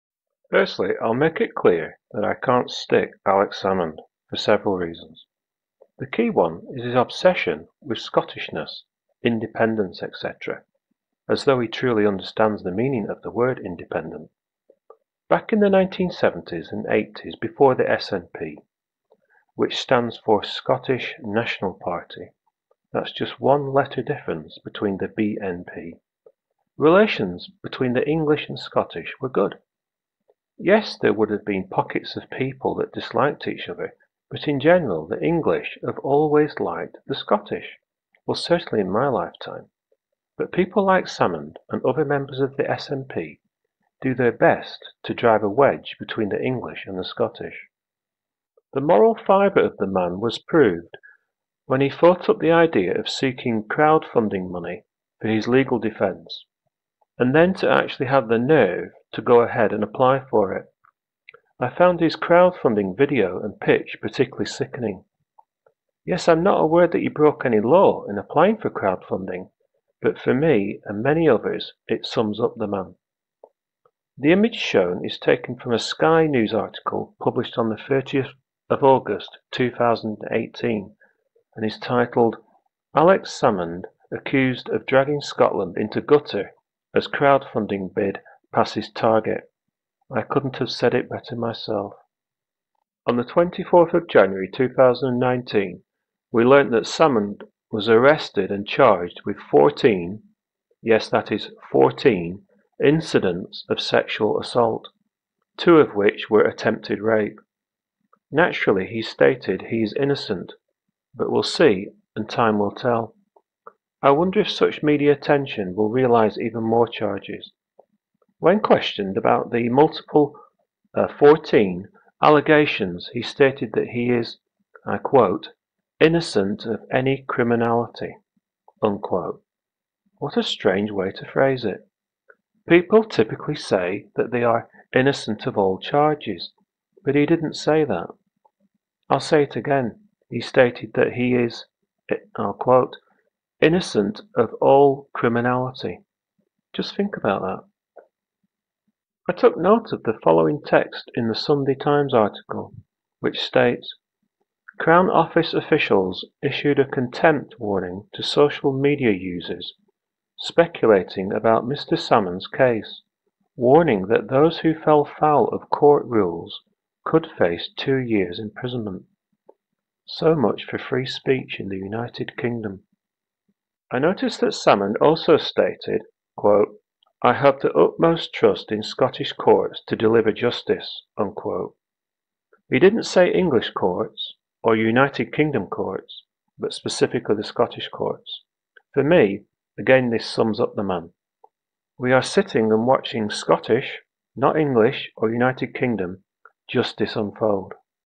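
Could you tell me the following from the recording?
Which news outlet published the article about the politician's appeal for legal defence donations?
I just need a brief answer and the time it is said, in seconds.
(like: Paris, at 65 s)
Sky News, at 75 s.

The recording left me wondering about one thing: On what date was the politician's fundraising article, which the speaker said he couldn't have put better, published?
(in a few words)
30 August 2018.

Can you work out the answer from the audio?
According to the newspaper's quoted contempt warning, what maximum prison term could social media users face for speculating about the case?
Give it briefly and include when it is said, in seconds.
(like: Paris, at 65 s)
2 years, at 167 s.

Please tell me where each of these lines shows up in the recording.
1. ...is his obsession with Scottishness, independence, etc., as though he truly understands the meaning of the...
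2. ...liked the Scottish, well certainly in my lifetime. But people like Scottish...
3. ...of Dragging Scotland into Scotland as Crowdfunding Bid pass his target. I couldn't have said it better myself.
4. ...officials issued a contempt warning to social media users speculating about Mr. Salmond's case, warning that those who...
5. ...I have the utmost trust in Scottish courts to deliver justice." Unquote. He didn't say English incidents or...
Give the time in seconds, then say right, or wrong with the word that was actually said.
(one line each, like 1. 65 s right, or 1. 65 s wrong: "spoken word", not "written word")
1. 6 s right
2. 36 s wrong: "Salmond", not "Scottish"
3. 84 s wrong: "Gutter", not "Scotland"
4. 155 s right
5. 177 s wrong: "courts", not "incidents".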